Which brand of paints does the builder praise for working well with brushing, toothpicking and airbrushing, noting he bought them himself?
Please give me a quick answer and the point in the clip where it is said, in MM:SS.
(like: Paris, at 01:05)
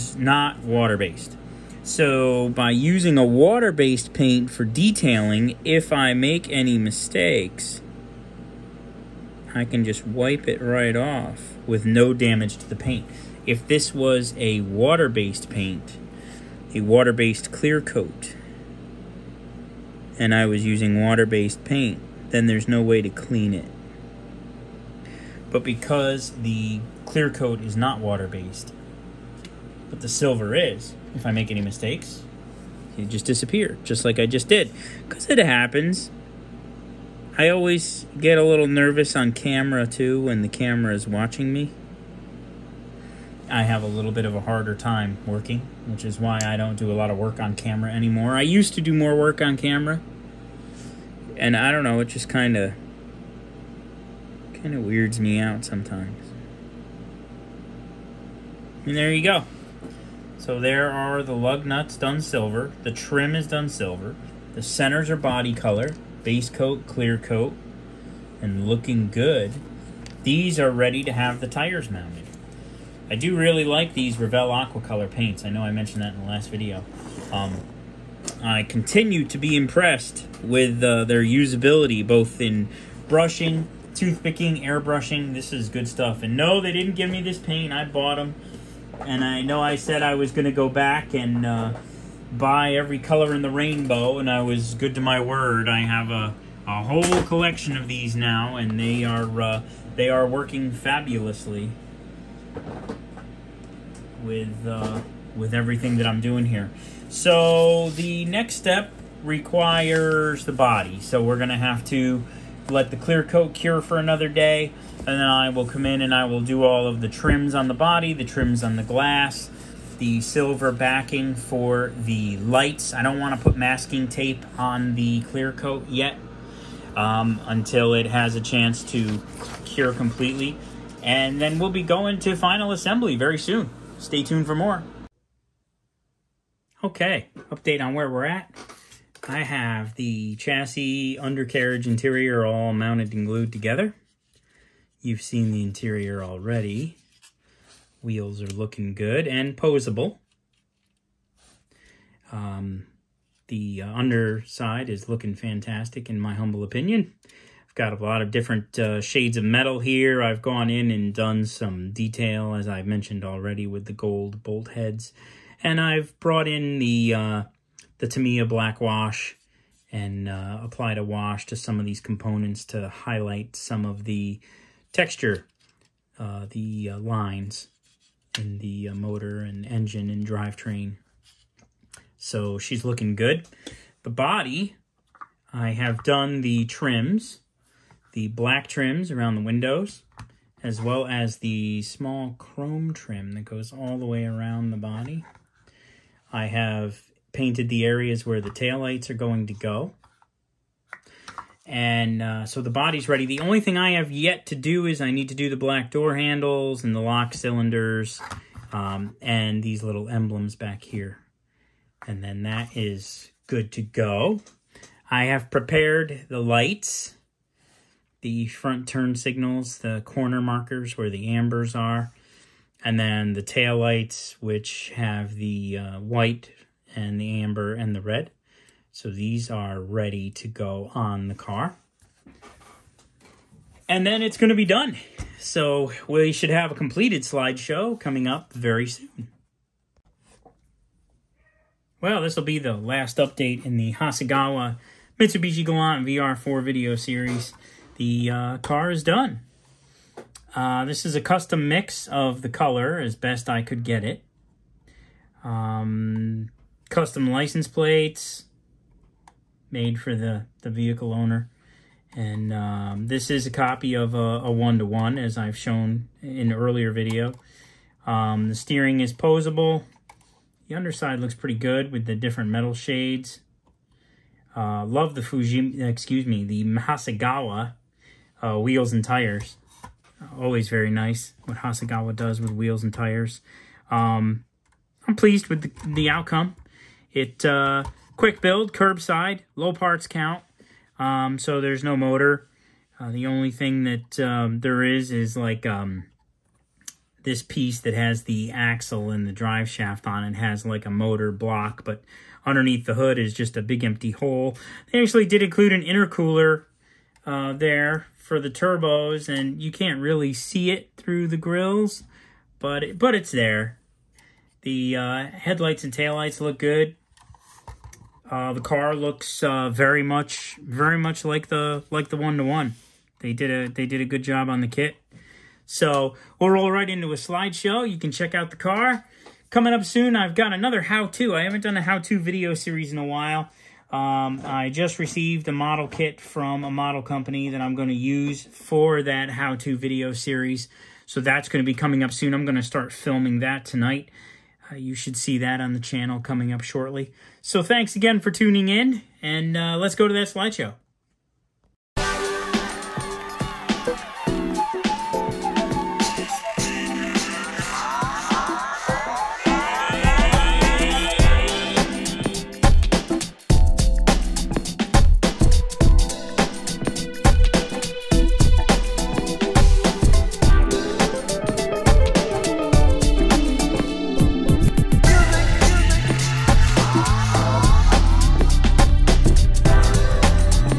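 Revell, at 01:14.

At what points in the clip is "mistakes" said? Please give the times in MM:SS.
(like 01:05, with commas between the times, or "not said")
00:06, 00:31.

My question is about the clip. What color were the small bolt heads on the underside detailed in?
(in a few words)
gold.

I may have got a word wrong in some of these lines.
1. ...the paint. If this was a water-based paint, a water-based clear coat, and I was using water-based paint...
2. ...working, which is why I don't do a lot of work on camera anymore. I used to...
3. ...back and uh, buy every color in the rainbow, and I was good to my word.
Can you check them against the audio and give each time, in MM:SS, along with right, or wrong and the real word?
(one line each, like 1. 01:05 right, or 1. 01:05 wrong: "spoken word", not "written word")
1. 00:12 right
2. 00:45 right
3. 01:30 right.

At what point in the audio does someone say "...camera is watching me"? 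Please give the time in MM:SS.
00:40.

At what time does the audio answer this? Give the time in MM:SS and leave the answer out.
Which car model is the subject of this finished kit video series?
04:05.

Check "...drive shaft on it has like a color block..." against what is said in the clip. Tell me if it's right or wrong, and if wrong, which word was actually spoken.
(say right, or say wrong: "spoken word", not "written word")
wrong: "motor", not "color".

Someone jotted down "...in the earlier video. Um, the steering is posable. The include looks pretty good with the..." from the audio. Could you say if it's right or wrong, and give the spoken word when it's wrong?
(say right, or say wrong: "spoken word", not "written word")
wrong: "underside", not "include".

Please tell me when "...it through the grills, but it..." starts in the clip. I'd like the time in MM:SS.
05:10.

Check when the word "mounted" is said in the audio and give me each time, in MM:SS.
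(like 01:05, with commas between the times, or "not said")
01:11, 02:22.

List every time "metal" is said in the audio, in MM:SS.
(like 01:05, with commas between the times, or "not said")
02:39, 04:32.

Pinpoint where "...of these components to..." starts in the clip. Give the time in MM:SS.
02:51.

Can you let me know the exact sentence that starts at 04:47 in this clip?
It uh, Quick build, curbside, low parts count.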